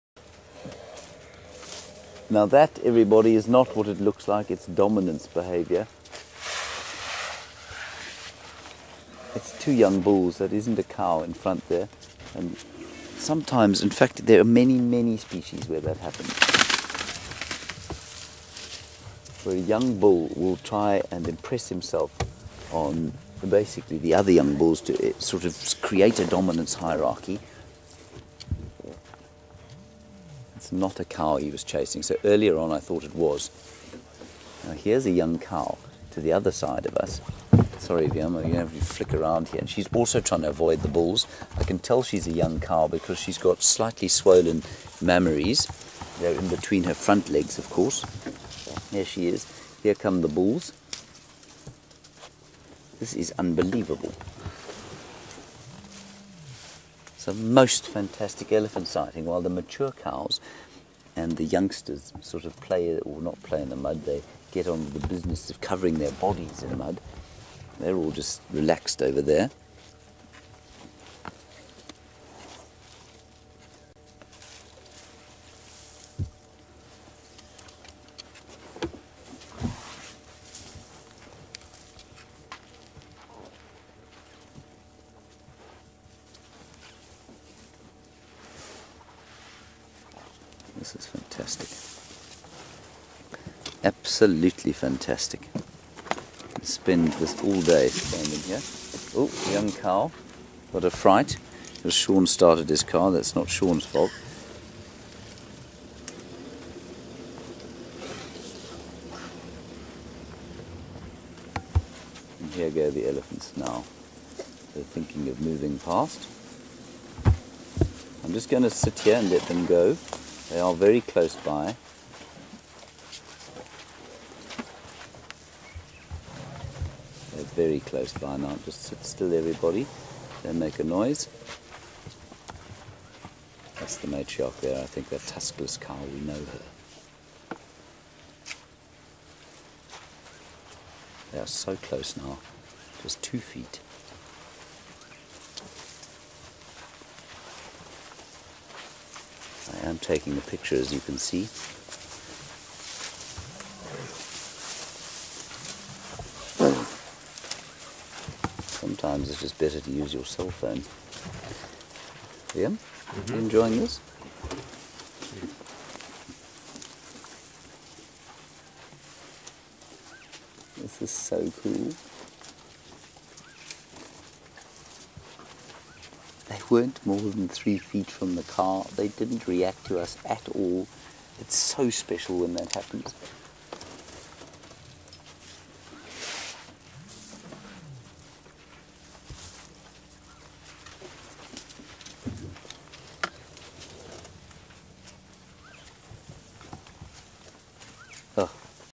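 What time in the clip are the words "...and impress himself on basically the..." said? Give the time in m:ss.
0:21.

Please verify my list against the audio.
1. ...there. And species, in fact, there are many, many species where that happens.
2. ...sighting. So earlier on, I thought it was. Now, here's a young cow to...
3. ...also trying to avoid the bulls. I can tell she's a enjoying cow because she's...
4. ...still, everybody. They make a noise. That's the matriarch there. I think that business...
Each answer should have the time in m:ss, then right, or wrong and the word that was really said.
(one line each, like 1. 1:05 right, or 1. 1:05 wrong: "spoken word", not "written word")
1. 0:11 wrong: "sometimes", not "species"
2. 0:31 wrong: "chasing", not "sighting"
3. 0:39 wrong: "young", not "enjoying"
4. 2:09 wrong: "tuskless", not "business".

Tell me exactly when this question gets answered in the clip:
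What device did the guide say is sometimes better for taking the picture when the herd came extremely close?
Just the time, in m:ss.
2:40.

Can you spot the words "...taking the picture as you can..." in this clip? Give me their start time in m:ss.
2:29.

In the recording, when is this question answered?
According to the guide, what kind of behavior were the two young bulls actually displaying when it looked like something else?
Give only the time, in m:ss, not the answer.
0:04.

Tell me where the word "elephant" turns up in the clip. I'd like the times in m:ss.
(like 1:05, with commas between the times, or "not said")
0:58, 1:53.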